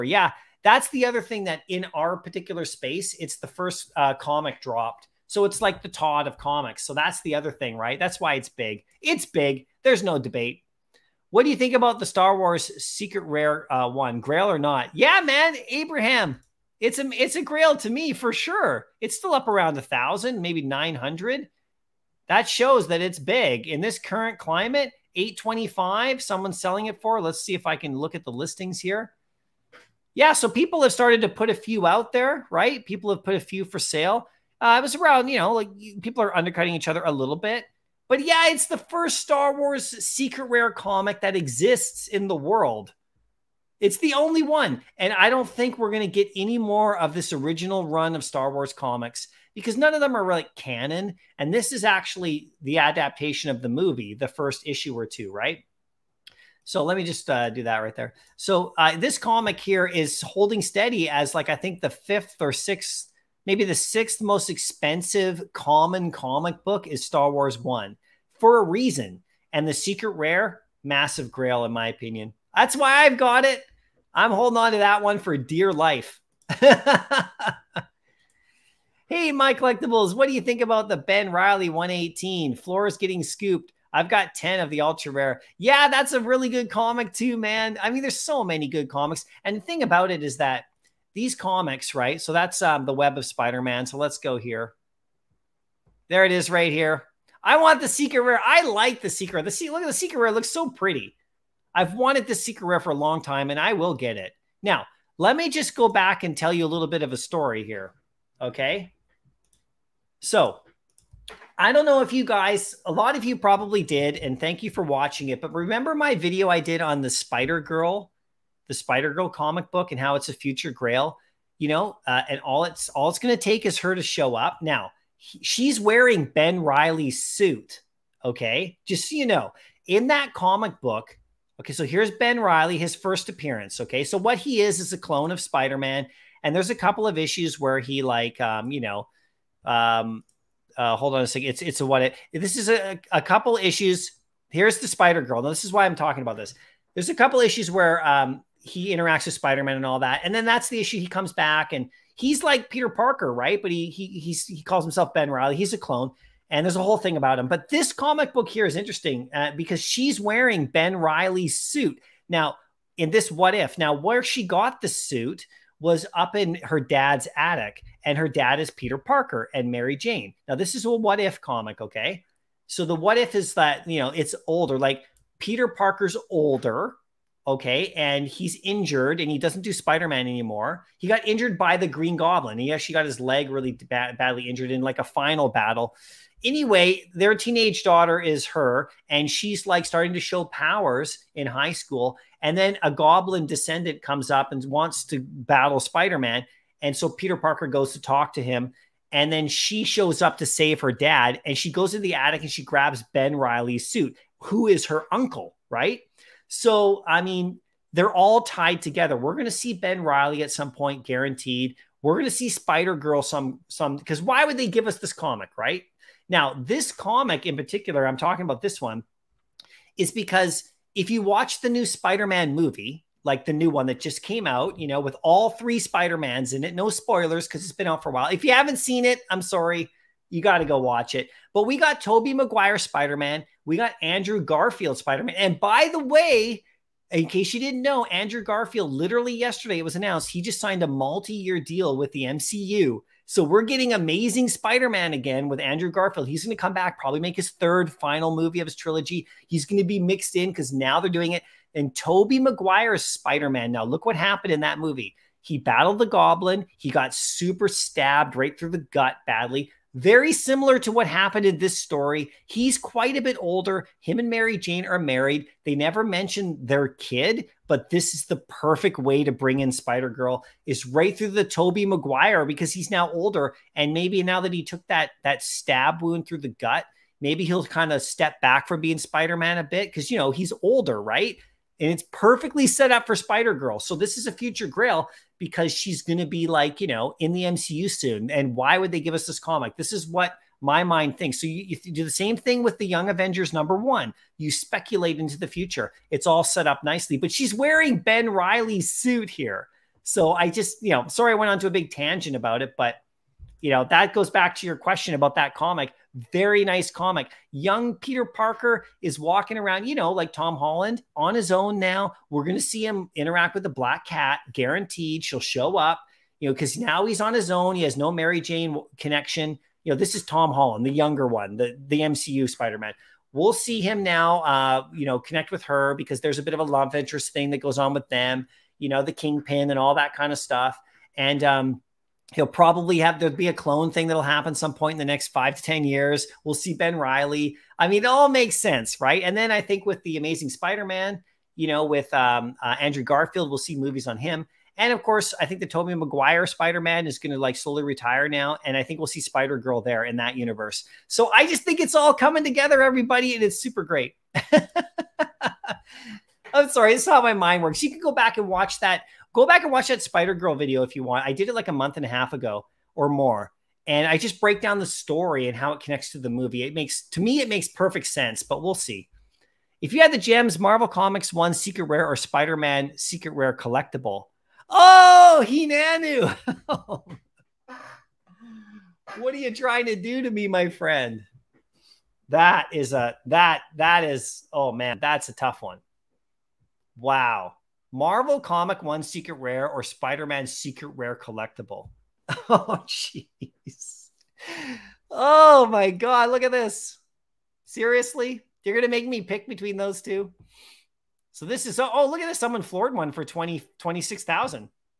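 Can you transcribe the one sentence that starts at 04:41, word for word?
and it's perfectly set up for Spider Girl.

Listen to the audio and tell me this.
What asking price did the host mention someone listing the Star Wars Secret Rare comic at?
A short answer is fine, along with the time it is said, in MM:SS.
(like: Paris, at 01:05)
825, at 00:25.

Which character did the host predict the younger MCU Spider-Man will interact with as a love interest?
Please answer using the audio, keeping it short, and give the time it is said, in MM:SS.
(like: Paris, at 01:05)
the Black Cat, at 05:13.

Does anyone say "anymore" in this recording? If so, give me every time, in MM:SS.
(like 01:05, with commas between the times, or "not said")
03:00.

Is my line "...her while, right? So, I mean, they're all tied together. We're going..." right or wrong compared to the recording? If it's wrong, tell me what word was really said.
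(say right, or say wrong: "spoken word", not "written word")
wrong: "uncle", not "while".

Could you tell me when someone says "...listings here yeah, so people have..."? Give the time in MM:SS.
00:28.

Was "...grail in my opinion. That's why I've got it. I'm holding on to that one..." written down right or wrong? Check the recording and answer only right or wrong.
right.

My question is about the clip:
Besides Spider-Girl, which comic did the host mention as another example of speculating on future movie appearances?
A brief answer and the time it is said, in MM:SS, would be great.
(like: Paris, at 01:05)
Young Avengers number one, at 04:52.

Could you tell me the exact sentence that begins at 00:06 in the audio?
So that's the other thing, right?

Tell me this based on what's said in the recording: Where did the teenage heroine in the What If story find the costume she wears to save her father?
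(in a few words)
her dad's attic.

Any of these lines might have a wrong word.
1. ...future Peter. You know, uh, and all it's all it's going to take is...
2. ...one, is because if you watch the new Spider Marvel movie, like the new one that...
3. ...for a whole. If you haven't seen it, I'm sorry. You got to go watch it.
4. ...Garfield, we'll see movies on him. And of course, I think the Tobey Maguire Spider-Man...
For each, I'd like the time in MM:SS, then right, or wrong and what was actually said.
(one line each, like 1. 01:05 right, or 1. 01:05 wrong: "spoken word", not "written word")
1. 02:00 wrong: "Grail", not "Peter"
2. 03:38 wrong: "Man", not "Marvel"
3. 03:48 wrong: "while", not "whole"
4. 05:43 right.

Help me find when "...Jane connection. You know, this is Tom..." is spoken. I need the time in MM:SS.
05:18.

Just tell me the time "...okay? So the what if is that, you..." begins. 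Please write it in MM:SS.
02:51.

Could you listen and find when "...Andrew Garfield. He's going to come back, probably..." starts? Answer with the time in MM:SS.
04:05.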